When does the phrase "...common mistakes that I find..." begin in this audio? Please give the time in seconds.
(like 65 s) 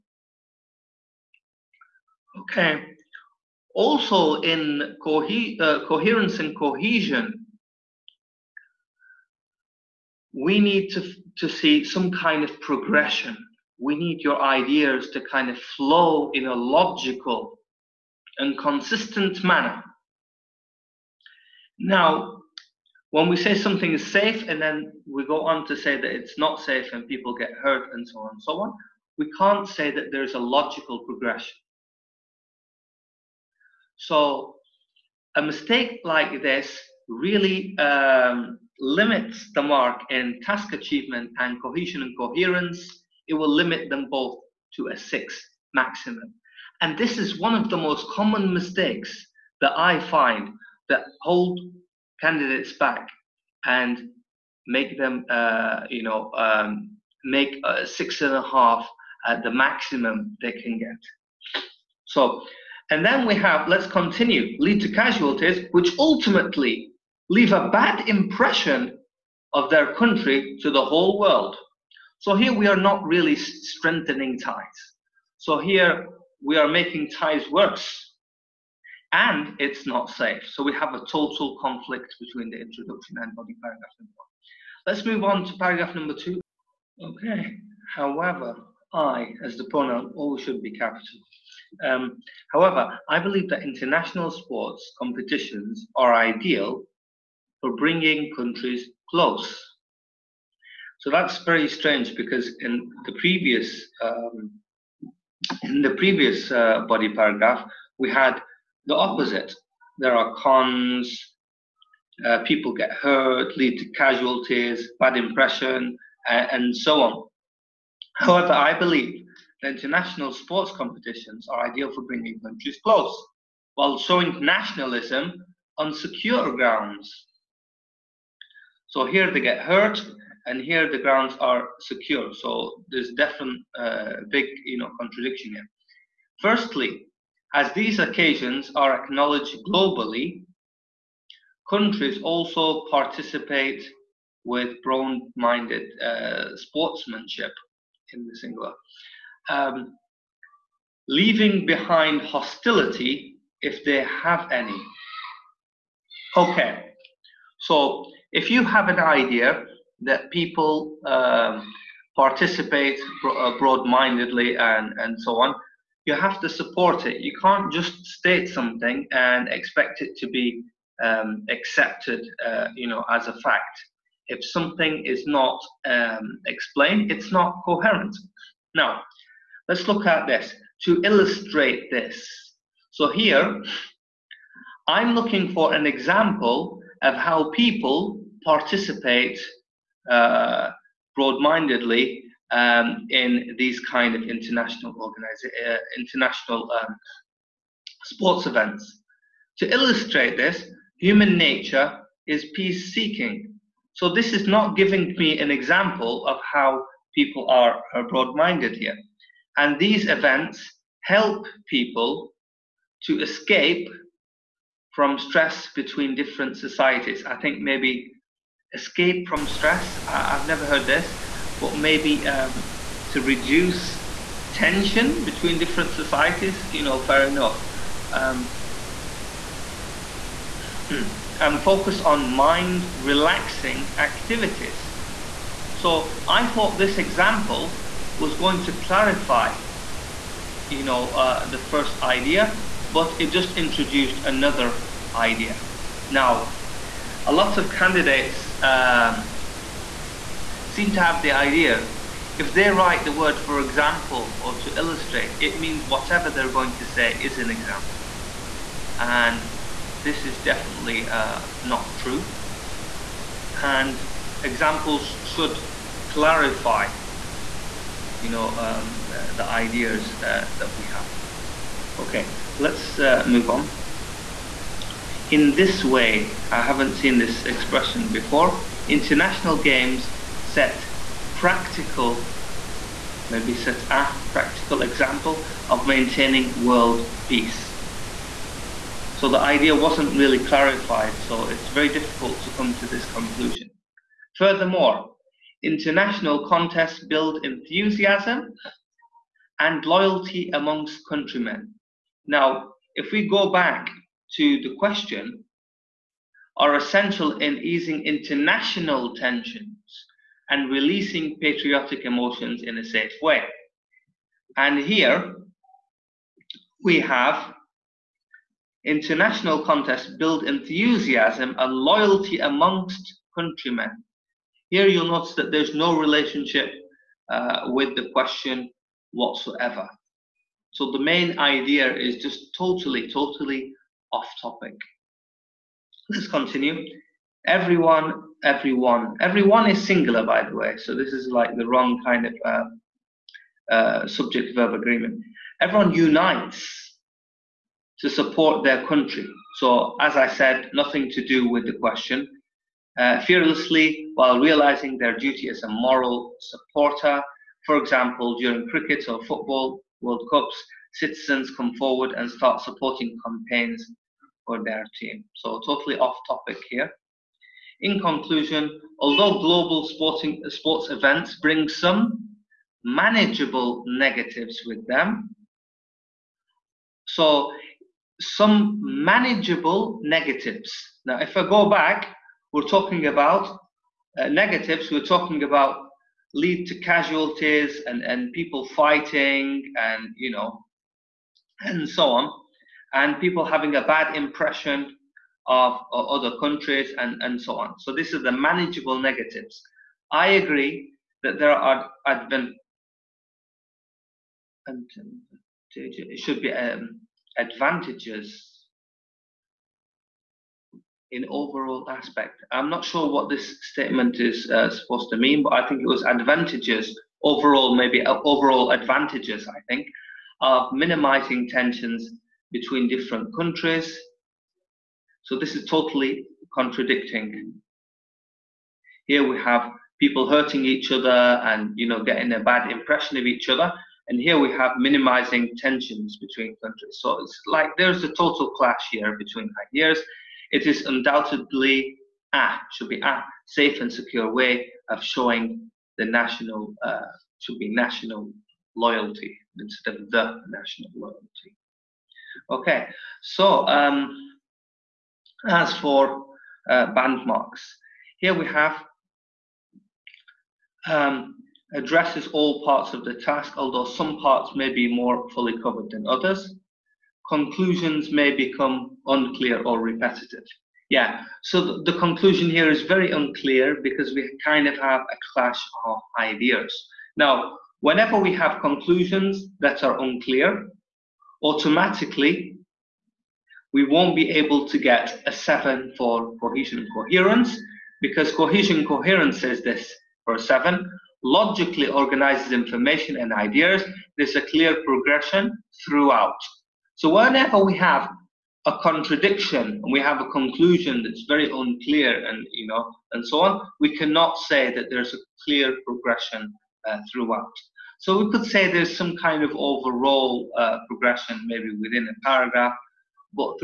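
48 s.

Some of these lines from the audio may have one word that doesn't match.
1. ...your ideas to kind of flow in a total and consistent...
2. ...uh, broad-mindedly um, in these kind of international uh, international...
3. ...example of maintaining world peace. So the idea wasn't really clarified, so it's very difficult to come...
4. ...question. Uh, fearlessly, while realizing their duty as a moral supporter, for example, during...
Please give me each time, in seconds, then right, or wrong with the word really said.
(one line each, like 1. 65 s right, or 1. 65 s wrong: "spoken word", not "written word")
1. 14 s wrong: "logical", not "total"
2. 190 s right
3. 284 s right
4. 351 s right.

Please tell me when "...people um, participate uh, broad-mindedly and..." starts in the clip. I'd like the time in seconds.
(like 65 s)
160 s.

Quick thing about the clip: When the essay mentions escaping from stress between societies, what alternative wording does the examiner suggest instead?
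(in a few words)
reduce tension.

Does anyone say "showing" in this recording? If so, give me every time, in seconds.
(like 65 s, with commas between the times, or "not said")
123 s, 445 s.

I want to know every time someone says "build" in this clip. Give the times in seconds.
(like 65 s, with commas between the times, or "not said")
297 s, 320 s.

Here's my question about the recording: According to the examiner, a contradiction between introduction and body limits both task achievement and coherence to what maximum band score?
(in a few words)
6.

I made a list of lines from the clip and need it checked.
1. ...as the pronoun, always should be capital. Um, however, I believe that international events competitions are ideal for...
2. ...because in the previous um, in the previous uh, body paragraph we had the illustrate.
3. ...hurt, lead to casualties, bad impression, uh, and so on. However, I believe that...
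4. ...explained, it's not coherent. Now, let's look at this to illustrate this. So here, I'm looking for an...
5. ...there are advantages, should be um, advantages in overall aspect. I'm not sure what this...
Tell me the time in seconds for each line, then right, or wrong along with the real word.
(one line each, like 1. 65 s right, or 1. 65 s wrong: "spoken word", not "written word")
1. 89 s wrong: "sports", not "events"
2. 102 s wrong: "opposite", not "illustrate"
3. 112 s right
4. 176 s right
5. 401 s right.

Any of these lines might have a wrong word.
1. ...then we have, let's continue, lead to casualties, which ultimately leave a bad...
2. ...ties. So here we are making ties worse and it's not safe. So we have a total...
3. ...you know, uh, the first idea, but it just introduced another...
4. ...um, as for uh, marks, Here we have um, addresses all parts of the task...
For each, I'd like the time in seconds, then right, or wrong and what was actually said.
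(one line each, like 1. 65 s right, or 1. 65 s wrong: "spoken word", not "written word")
1. 63 s right
2. 74 s right
3. 240 s right
4. 453 s right.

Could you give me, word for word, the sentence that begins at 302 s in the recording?
Now, if we go back to the question, are essential in easing international tensions and releasing patriotic emotions in a safe way.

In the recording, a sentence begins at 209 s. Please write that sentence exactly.
And these events help people to escape from stress between different societies.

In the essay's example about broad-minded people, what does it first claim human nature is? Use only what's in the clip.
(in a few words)
peace seeking.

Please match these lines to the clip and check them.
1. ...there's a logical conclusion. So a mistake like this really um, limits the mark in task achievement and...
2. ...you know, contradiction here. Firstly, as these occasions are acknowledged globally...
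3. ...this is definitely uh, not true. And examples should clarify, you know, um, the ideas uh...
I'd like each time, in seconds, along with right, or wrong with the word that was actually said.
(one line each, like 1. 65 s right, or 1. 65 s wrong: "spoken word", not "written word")
1. 30 s wrong: "progression", not "conclusion"
2. 134 s right
3. 259 s right.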